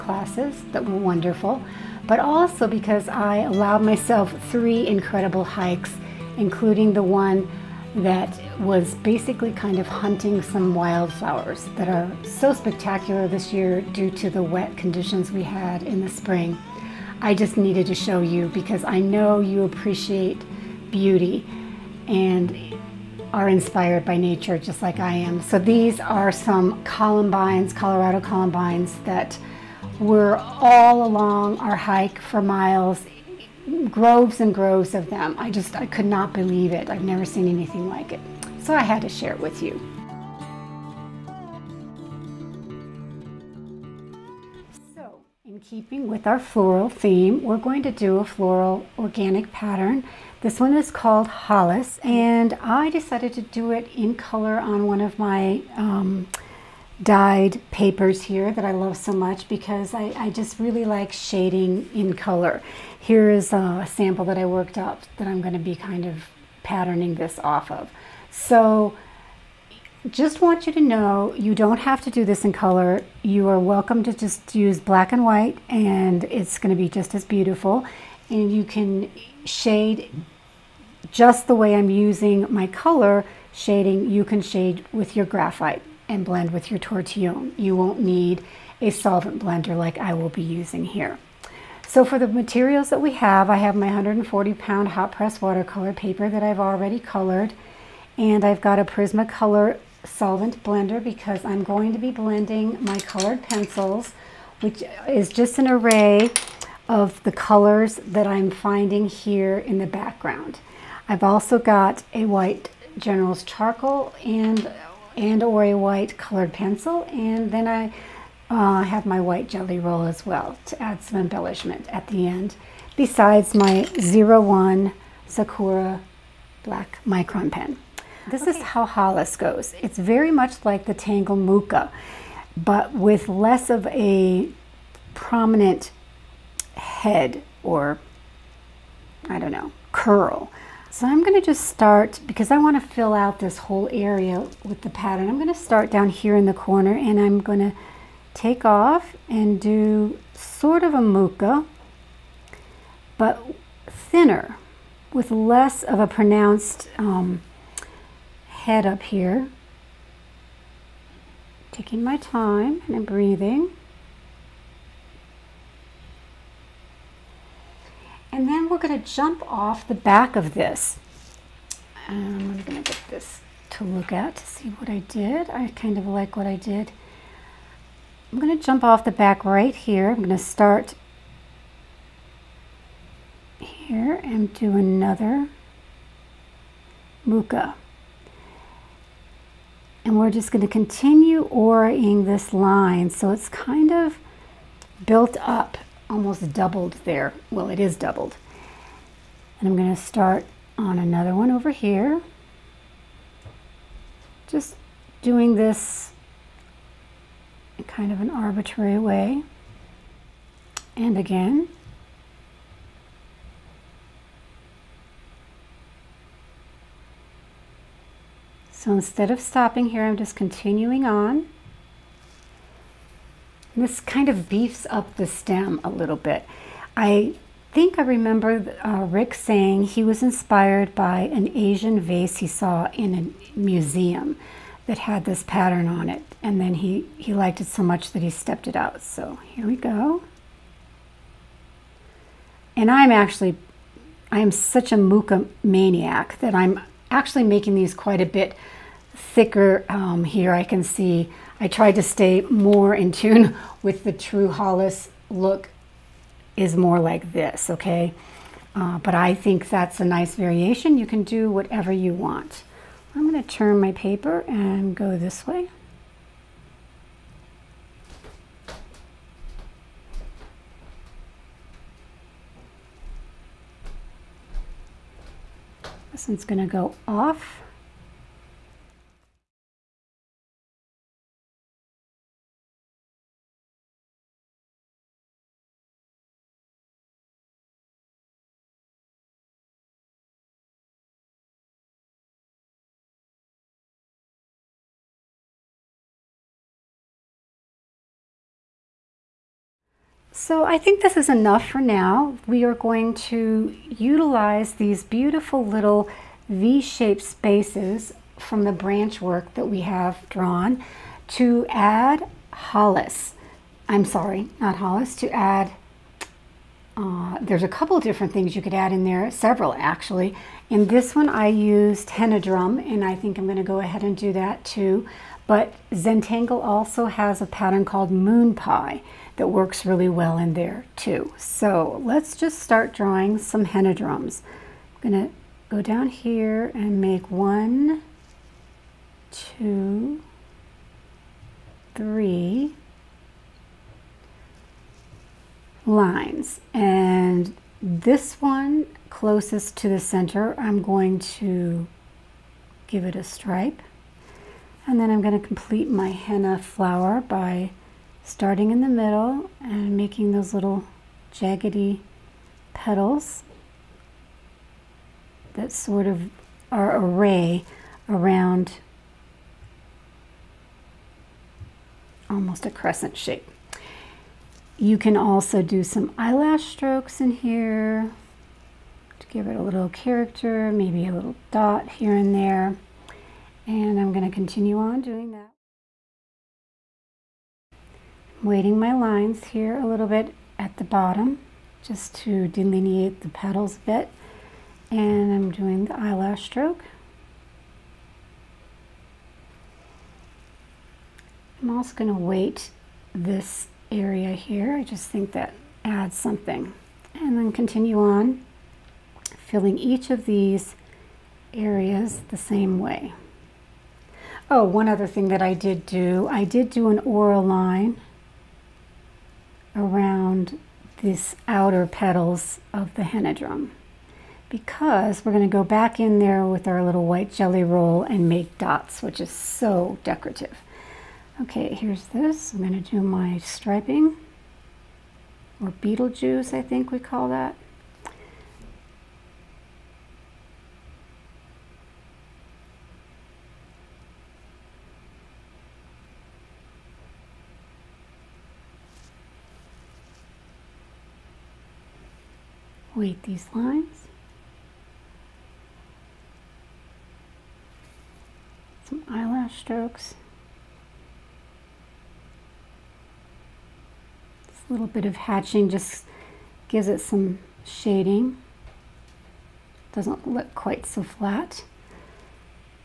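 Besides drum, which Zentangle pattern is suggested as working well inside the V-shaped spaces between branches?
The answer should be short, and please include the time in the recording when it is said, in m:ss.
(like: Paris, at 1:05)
Moon Pie, at 5:28.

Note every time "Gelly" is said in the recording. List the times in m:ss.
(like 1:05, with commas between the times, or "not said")
1:59, 7:07.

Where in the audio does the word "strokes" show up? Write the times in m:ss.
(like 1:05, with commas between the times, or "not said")
6:16, 6:36, 7:39.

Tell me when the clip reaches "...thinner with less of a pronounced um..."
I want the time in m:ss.
2:33.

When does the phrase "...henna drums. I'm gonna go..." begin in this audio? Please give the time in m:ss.
5:33.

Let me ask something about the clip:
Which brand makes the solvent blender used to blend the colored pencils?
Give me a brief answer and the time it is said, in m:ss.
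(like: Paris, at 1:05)
Prismacolor, at 1:38.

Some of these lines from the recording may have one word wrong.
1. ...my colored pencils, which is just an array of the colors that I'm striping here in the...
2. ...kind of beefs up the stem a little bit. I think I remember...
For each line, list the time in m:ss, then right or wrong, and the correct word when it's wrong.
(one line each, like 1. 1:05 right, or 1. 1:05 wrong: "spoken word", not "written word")
1. 1:42 wrong: "finding", not "striping"
2. 3:43 right.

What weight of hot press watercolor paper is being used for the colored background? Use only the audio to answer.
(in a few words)
140 pound.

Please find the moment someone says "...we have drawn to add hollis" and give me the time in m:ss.
5:09.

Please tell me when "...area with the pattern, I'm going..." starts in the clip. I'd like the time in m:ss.
2:23.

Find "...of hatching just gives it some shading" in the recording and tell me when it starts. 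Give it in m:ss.
7:45.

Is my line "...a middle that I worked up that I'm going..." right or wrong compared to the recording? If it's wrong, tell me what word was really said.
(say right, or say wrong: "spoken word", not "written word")
wrong: "sample", not "middle".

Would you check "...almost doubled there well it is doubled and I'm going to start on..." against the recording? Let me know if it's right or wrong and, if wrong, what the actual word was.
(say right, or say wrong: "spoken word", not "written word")
right.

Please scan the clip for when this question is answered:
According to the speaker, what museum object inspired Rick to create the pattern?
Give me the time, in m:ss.
3:51.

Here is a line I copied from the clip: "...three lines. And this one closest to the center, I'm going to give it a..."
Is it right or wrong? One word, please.
right.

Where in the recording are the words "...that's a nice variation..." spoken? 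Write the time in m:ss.
4:19.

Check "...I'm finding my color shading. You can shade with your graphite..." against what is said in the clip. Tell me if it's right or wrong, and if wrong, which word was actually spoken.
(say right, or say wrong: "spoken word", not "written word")
wrong: "using", not "finding".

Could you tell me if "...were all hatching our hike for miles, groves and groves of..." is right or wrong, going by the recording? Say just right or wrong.
wrong.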